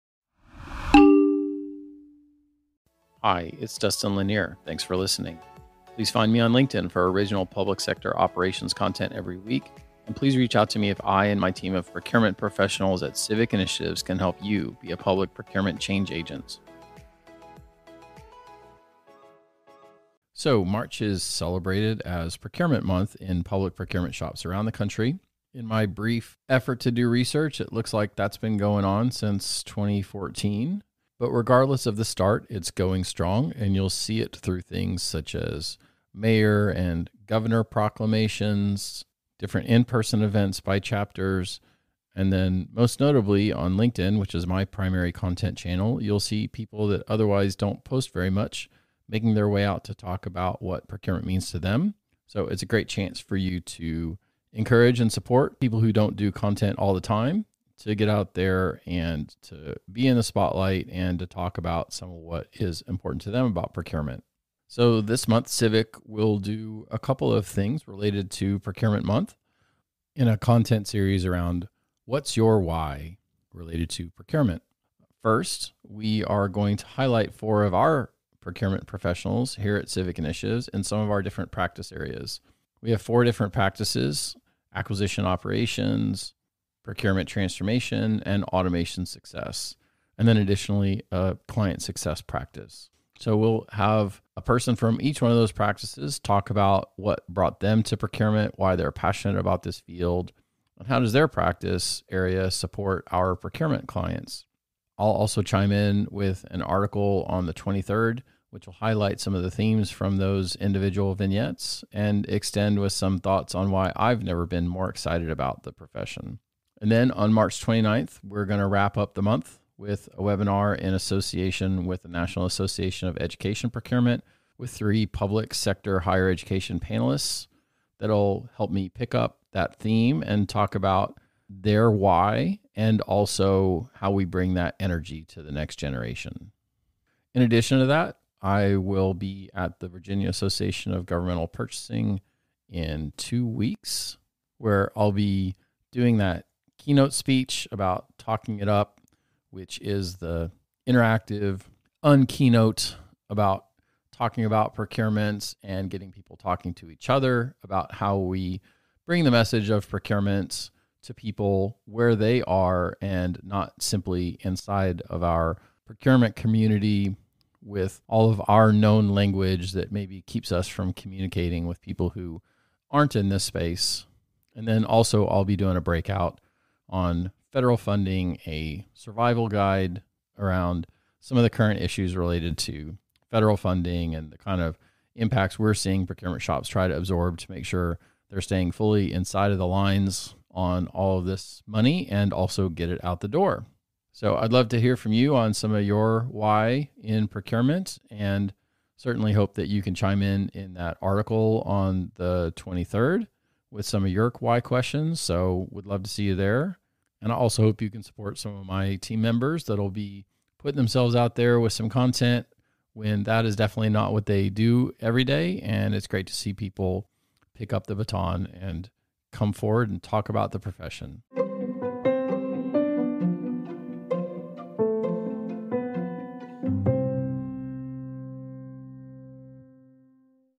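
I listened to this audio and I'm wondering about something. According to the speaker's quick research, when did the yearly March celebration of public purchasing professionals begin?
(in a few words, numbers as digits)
2014.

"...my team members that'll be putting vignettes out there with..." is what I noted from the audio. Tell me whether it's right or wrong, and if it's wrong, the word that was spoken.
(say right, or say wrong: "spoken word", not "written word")
wrong: "themselves", not "vignettes".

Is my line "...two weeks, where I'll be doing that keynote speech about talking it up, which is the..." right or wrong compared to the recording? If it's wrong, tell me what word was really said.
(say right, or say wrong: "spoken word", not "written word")
right.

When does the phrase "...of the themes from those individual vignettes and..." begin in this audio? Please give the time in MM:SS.
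01:49.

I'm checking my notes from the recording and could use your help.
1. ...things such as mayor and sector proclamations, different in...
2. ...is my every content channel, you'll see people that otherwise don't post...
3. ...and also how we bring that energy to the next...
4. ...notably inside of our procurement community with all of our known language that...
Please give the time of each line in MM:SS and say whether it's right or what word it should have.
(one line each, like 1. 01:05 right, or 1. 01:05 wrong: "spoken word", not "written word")
1. 00:34 wrong: "governor", not "sector"
2. 00:44 wrong: "primary", not "every"
3. 02:12 right
4. 02:43 wrong: "simply", not "notably".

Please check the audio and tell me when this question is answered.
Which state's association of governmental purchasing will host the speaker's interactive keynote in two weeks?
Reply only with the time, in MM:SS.
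02:19.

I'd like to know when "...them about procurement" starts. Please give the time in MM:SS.
01:03.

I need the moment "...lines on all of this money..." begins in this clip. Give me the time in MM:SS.
03:09.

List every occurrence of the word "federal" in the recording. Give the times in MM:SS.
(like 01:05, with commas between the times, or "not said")
02:57, 03:03.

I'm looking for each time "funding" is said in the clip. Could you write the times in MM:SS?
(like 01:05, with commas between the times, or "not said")
02:57, 03:03.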